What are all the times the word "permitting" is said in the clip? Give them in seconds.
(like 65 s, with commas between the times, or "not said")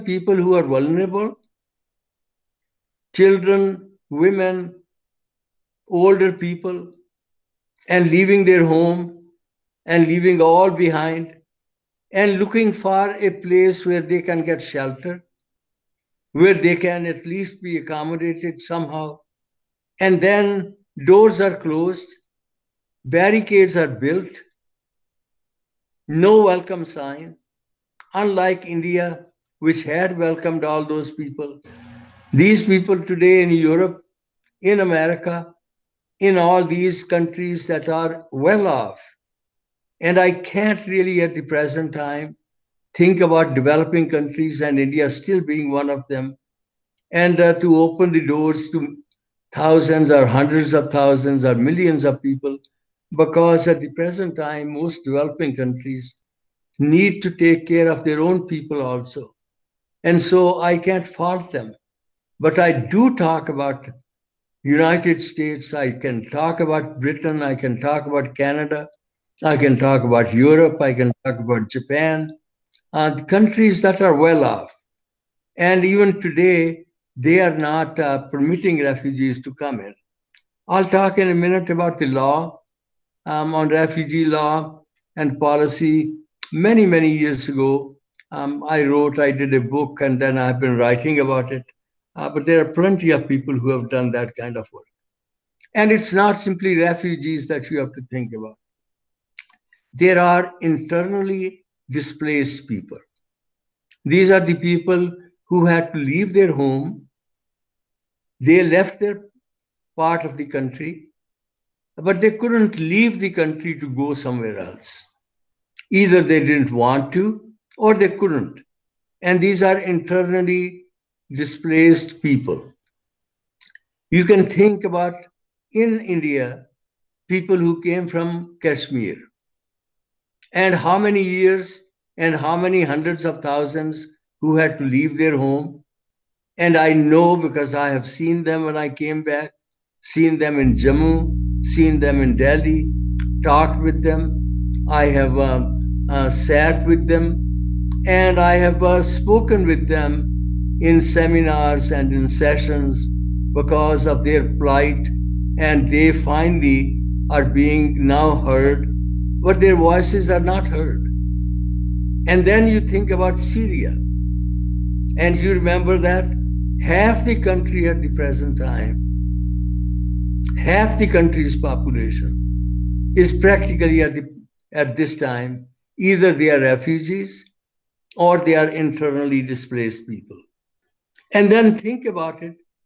78 s.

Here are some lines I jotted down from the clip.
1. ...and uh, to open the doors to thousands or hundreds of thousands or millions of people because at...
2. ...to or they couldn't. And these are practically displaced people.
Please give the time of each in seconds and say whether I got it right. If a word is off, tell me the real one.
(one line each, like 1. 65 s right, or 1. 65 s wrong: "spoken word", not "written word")
1. 47 s right
2. 117 s wrong: "internally", not "practically".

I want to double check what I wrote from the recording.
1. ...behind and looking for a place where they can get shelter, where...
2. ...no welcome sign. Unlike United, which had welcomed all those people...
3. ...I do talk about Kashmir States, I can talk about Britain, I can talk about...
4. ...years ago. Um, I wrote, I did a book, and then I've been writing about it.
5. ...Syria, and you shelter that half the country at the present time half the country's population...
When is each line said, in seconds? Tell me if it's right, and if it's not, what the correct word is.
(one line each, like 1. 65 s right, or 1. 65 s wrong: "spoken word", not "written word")
1. 10 s right
2. 26 s wrong: "India", not "United"
3. 62 s wrong: "United", not "Kashmir"
4. 87 s right
5. 163 s wrong: "remember", not "shelter".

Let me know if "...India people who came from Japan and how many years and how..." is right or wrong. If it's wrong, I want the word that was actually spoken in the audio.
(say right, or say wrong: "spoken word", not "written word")
wrong: "Kashmir", not "Japan".